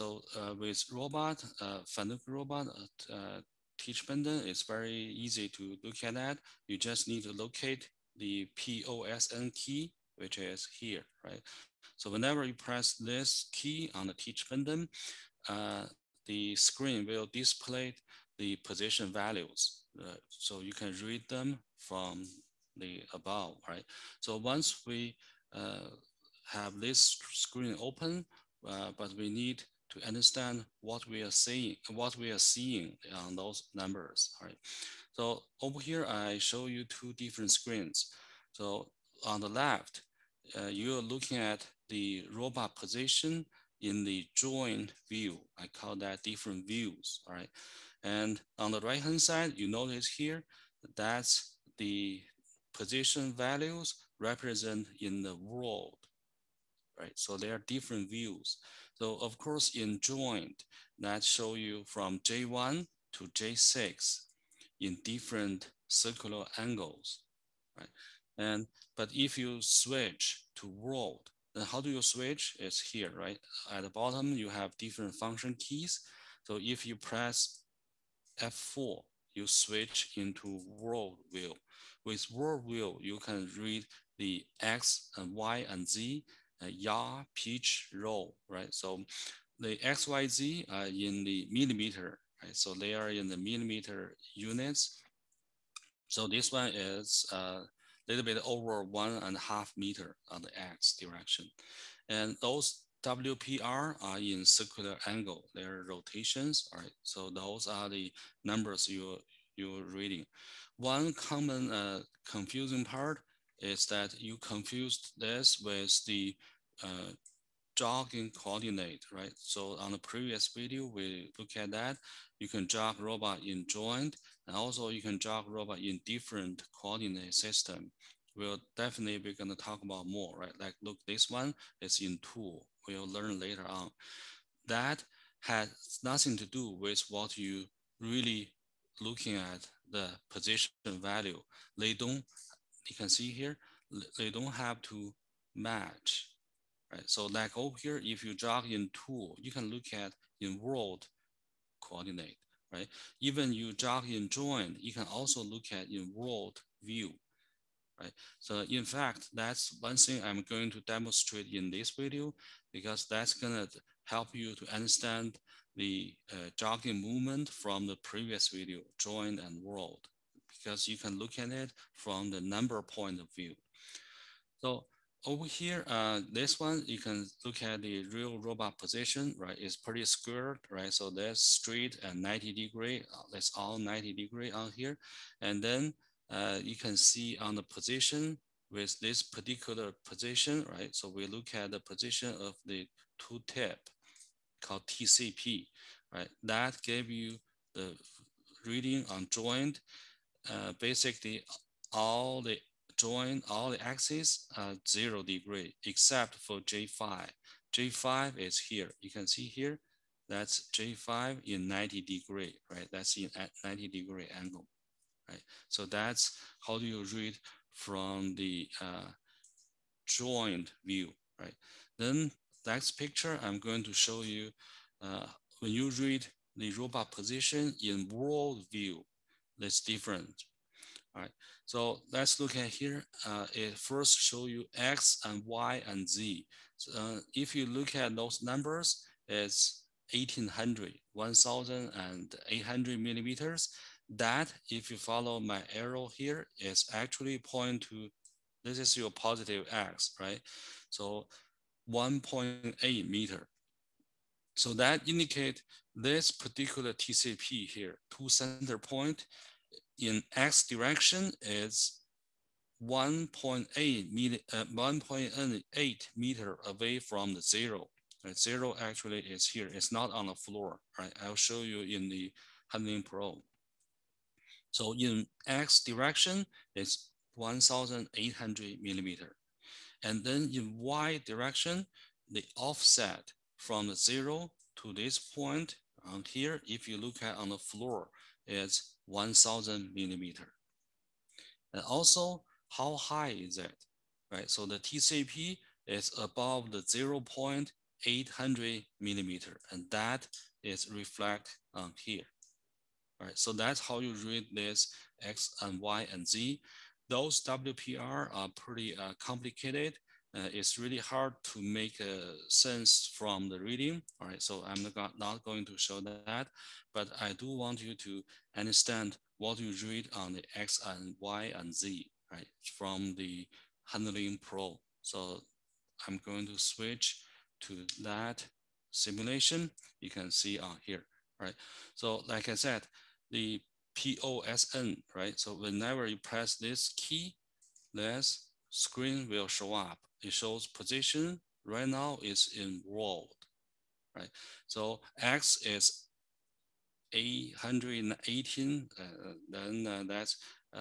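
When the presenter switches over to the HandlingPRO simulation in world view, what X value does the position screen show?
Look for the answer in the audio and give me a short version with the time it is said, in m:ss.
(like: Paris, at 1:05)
818, at 5:47.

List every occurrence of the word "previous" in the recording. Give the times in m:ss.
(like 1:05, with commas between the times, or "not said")
1:59, 2:48.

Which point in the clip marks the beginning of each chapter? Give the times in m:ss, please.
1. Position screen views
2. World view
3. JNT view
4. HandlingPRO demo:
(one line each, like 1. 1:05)
1. 0:41
2. 3:41
3. 2:51
4. 5:31.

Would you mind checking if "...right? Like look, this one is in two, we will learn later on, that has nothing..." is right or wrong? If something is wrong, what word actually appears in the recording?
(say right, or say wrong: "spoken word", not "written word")
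right.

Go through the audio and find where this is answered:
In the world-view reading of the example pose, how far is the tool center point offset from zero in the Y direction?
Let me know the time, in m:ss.
4:49.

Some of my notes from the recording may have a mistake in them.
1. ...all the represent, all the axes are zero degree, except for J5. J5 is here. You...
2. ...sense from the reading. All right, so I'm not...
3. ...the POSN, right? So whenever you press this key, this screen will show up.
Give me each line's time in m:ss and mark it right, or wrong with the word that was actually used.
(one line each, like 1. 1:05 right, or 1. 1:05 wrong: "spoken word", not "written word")
1. 3:21 wrong: "joint", not "represent"
2. 5:12 right
3. 5:33 right.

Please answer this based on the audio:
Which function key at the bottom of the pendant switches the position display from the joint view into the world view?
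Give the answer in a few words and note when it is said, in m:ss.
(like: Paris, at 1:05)
F4, at 1:18.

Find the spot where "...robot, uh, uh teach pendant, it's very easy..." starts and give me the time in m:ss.
0:02.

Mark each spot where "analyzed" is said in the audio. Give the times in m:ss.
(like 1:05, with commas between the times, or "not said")
not said.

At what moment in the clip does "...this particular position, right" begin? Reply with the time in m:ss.
3:08.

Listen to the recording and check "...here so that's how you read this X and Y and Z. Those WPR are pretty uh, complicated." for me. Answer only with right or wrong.
right.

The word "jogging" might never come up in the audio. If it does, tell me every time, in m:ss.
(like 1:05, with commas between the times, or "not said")
1:57, 2:46.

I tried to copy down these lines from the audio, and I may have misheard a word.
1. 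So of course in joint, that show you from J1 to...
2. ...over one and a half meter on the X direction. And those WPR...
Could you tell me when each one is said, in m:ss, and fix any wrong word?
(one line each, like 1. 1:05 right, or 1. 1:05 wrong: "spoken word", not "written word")
1. 0:58 right
2. 1:38 right.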